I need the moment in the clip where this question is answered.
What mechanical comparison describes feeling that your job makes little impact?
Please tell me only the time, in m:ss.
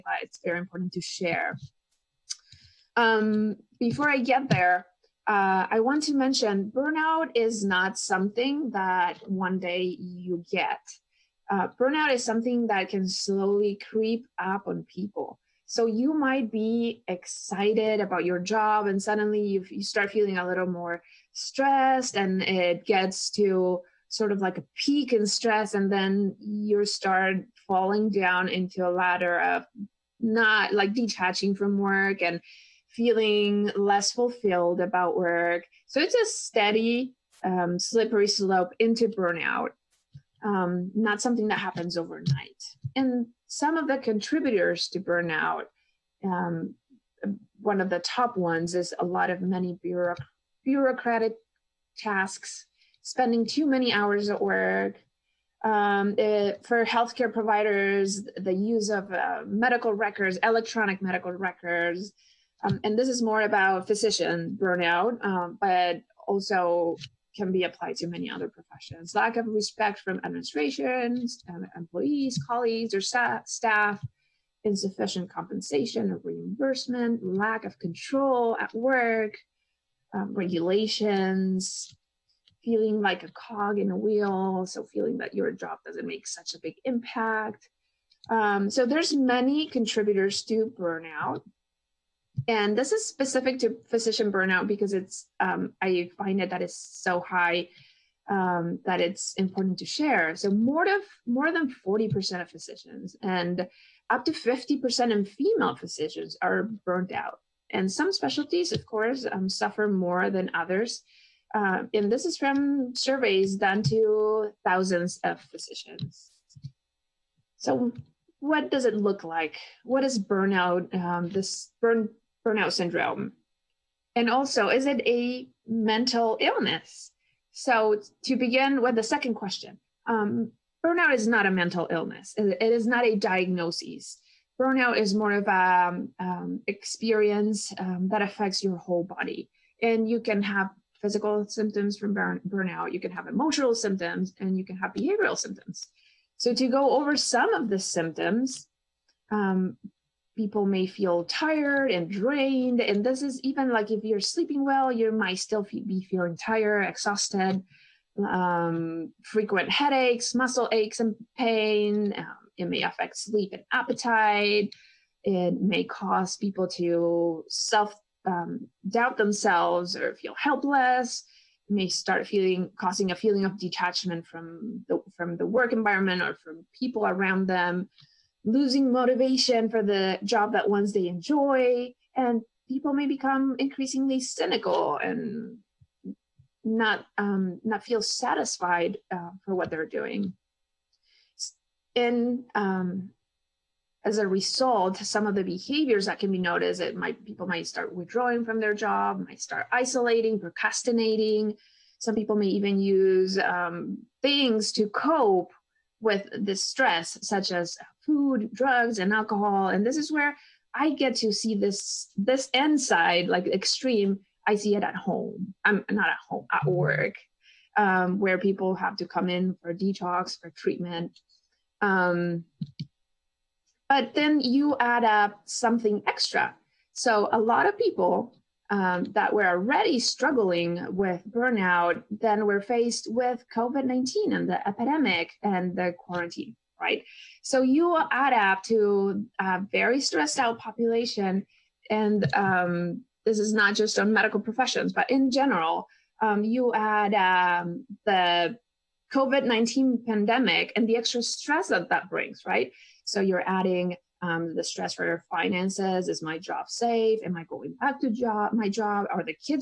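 1:23.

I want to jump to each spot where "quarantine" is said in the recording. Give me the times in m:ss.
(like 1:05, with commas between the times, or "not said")
3:55.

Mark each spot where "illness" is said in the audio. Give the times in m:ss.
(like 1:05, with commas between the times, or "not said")
2:06, 2:11.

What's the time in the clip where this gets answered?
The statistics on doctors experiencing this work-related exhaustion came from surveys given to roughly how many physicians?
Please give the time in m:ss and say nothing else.
1:54.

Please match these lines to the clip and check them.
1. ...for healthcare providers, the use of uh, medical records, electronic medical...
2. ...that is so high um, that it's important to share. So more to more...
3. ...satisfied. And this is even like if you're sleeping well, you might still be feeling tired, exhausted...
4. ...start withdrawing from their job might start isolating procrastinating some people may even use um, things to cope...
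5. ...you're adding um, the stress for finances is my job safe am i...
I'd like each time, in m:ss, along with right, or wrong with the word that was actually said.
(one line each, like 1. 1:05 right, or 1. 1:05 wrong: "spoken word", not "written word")
1. 0:56 right
2. 1:36 right
3. 2:32 wrong: "drained", not "satisfied"
4. 3:17 right
5. 4:13 right.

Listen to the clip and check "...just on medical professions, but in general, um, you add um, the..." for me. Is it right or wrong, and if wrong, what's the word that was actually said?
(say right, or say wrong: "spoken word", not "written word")
right.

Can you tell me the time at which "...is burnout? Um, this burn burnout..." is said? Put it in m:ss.
2:00.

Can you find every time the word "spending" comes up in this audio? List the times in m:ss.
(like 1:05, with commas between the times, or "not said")
0:53.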